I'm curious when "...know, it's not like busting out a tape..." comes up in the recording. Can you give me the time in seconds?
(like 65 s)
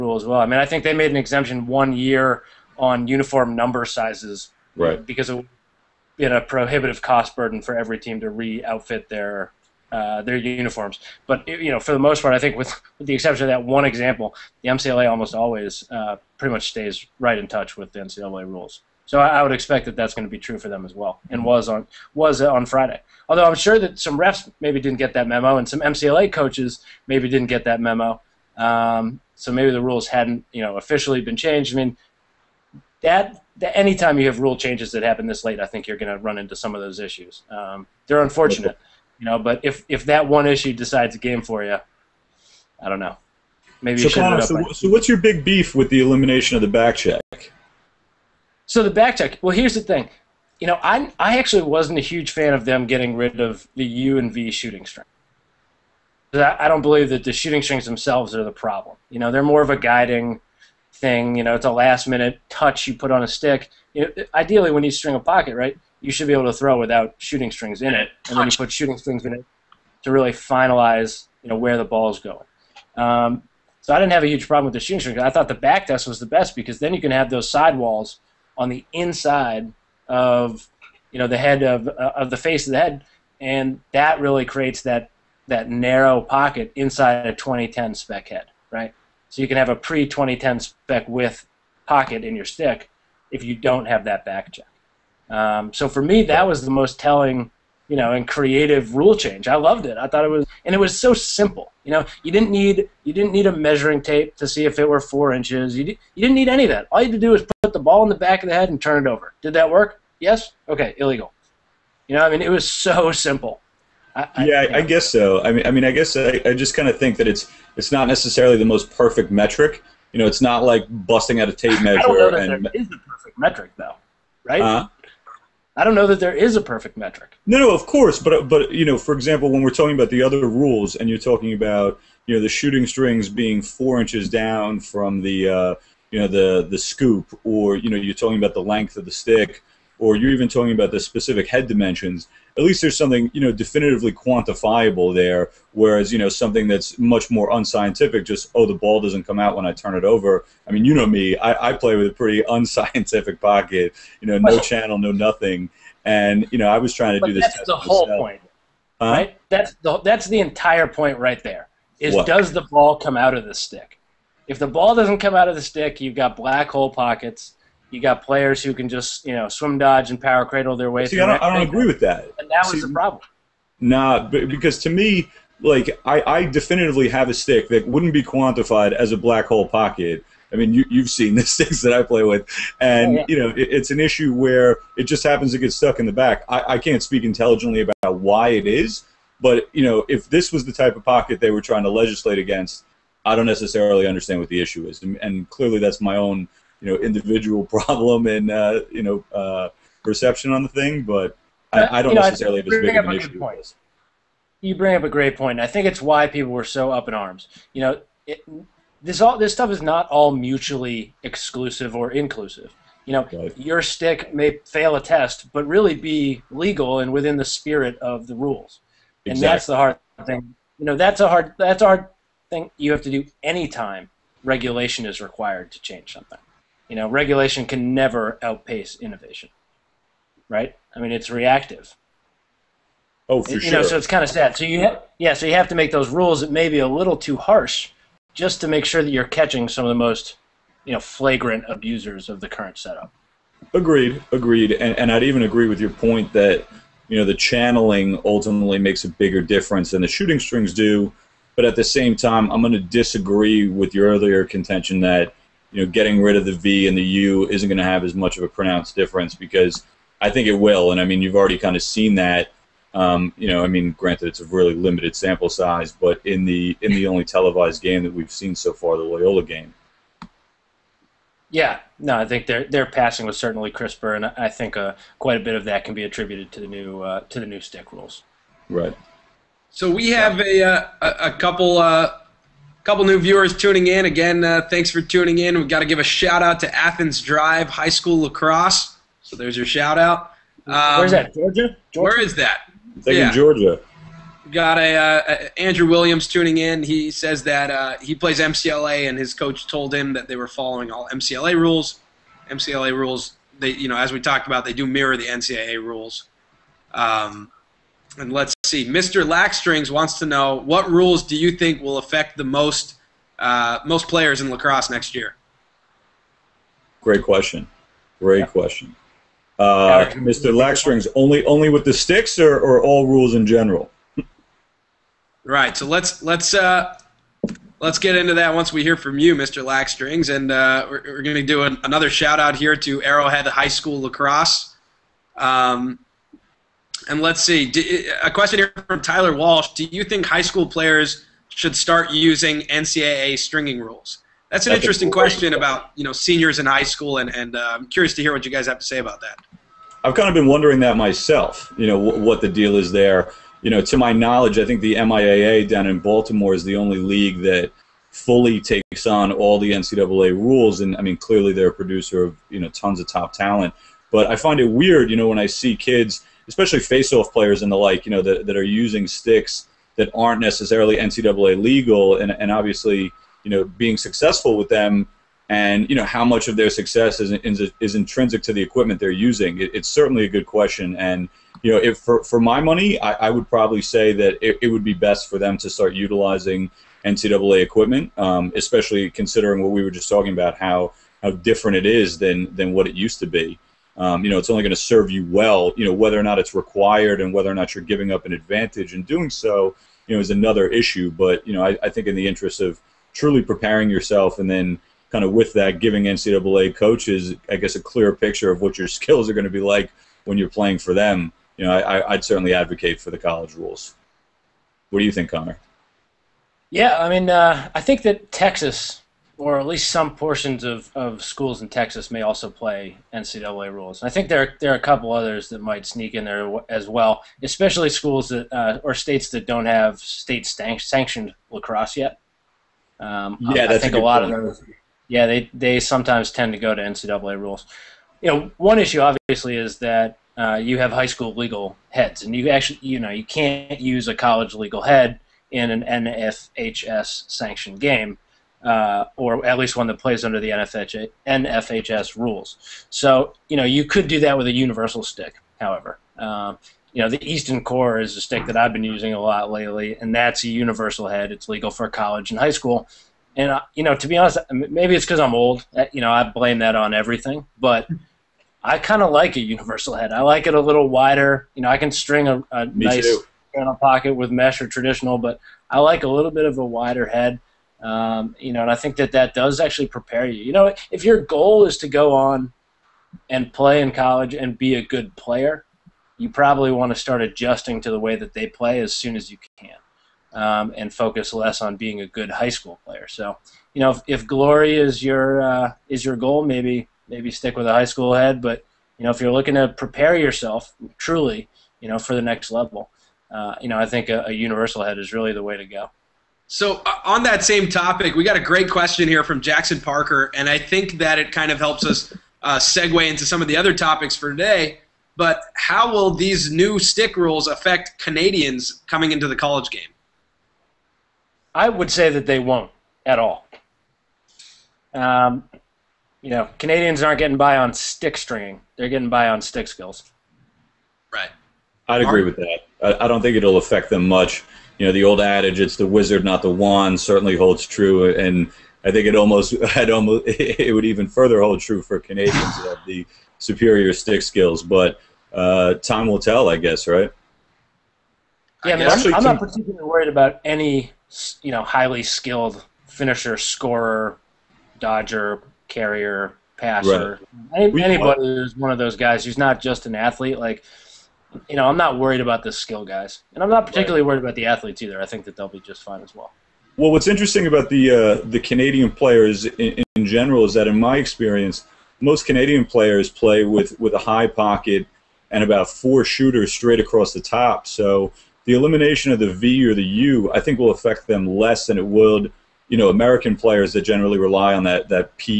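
120 s.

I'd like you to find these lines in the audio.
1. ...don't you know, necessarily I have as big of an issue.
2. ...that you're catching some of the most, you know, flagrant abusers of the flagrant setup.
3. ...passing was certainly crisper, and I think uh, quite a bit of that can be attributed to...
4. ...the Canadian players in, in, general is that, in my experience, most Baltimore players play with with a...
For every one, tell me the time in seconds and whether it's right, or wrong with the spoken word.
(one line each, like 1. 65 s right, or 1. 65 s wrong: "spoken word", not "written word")
1. 202 s right
2. 239 s wrong: "current", not "flagrant"
3. 272 s right
4. 568 s wrong: "Canadian", not "Baltimore".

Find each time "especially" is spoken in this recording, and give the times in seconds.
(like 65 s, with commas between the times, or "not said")
366 s, 388 s, 427 s.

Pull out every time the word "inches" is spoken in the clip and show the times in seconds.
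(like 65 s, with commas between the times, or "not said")
105 s, 133 s.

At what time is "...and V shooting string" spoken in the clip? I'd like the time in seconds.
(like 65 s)
54 s.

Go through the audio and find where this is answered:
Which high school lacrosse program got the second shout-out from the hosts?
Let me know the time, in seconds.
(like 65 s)
333 s.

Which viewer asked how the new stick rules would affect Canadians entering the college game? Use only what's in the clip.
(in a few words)
Jackson Parker.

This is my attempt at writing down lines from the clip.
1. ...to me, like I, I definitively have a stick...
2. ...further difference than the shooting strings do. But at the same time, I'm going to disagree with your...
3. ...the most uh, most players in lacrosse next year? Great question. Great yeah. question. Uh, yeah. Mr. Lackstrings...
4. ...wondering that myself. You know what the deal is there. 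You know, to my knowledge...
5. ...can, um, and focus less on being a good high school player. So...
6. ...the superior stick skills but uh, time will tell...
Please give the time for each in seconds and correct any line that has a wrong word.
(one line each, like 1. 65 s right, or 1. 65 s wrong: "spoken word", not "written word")
1. 174 s right
2. 249 s wrong: "bigger", not "further"
3. 312 s right
4. 350 s right
5. 489 s right
6. 542 s right.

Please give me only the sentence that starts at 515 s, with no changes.
But how will these new stick rules affect Canadians coming into the college game?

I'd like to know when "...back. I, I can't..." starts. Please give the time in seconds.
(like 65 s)
186 s.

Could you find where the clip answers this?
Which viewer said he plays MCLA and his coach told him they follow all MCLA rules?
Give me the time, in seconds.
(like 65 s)
295 s.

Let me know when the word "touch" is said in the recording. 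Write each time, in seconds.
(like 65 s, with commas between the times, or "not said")
17 s, 62 s.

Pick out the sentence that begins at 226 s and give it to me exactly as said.
You know, regulation can never outpace innovation, right?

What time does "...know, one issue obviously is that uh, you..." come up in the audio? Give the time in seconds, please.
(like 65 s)
438 s.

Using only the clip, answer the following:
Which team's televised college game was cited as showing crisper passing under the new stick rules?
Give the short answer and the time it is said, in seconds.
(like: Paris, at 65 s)
Loyola, at 268 s.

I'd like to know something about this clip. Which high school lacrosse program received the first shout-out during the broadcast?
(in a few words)
Athens Drive.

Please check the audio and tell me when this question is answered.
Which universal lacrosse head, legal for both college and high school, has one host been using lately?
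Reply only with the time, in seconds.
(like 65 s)
457 s.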